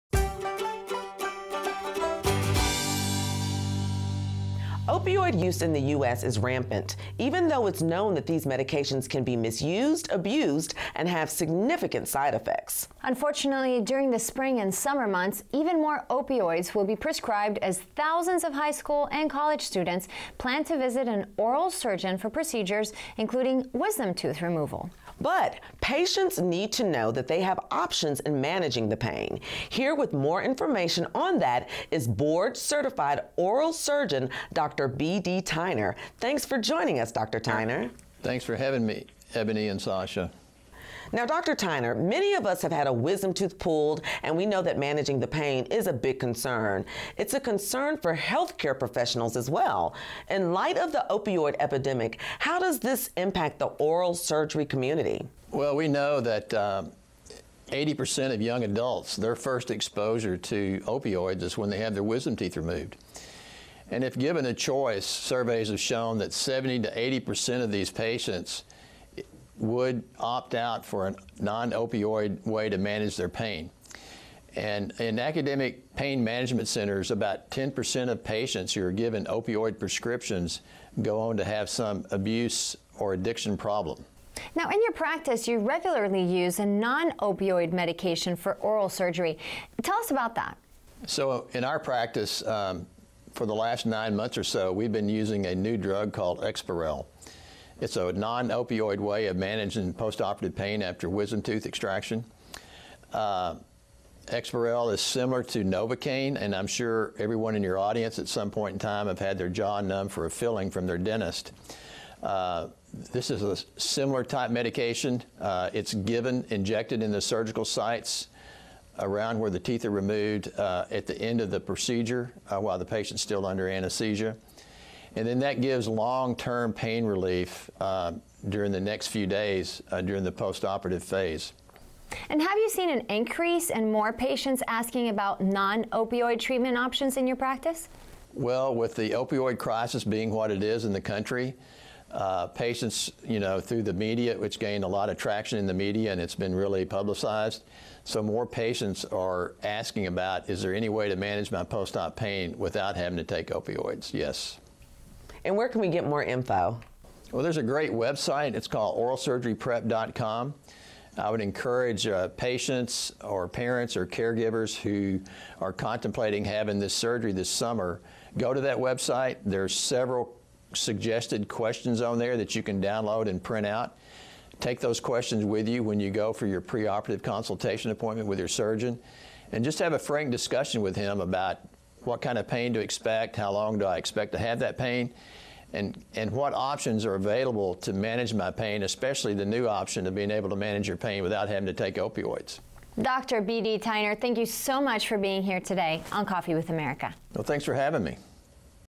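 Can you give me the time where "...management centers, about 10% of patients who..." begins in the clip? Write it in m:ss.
1:16.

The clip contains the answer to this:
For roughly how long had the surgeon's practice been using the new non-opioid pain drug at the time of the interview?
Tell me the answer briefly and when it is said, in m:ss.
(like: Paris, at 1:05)
9 months, at 1:33.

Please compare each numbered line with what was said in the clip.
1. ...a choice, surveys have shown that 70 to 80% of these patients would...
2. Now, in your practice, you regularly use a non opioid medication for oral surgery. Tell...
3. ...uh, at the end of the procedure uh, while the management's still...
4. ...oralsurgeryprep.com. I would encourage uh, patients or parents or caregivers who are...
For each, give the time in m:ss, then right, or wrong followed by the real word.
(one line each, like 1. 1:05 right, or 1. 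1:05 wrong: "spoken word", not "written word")
1. 1:04 right
2. 1:24 right
3. 2:00 wrong: "patient", not "management"
4. 2:38 right.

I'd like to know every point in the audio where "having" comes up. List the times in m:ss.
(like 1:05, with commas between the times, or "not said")
0:38, 2:32, 2:46, 3:11, 3:17.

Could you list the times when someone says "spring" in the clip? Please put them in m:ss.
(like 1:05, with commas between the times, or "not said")
0:14.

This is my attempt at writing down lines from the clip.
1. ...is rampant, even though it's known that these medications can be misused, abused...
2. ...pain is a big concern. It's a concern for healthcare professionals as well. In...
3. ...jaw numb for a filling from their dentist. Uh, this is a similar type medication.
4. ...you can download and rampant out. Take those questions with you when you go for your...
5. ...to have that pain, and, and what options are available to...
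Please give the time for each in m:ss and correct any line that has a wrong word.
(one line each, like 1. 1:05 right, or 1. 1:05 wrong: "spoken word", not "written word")
1. 0:06 right
2. 0:45 right
3. 1:49 right
4. 2:52 wrong: "print", not "rampant"
5. 3:04 right.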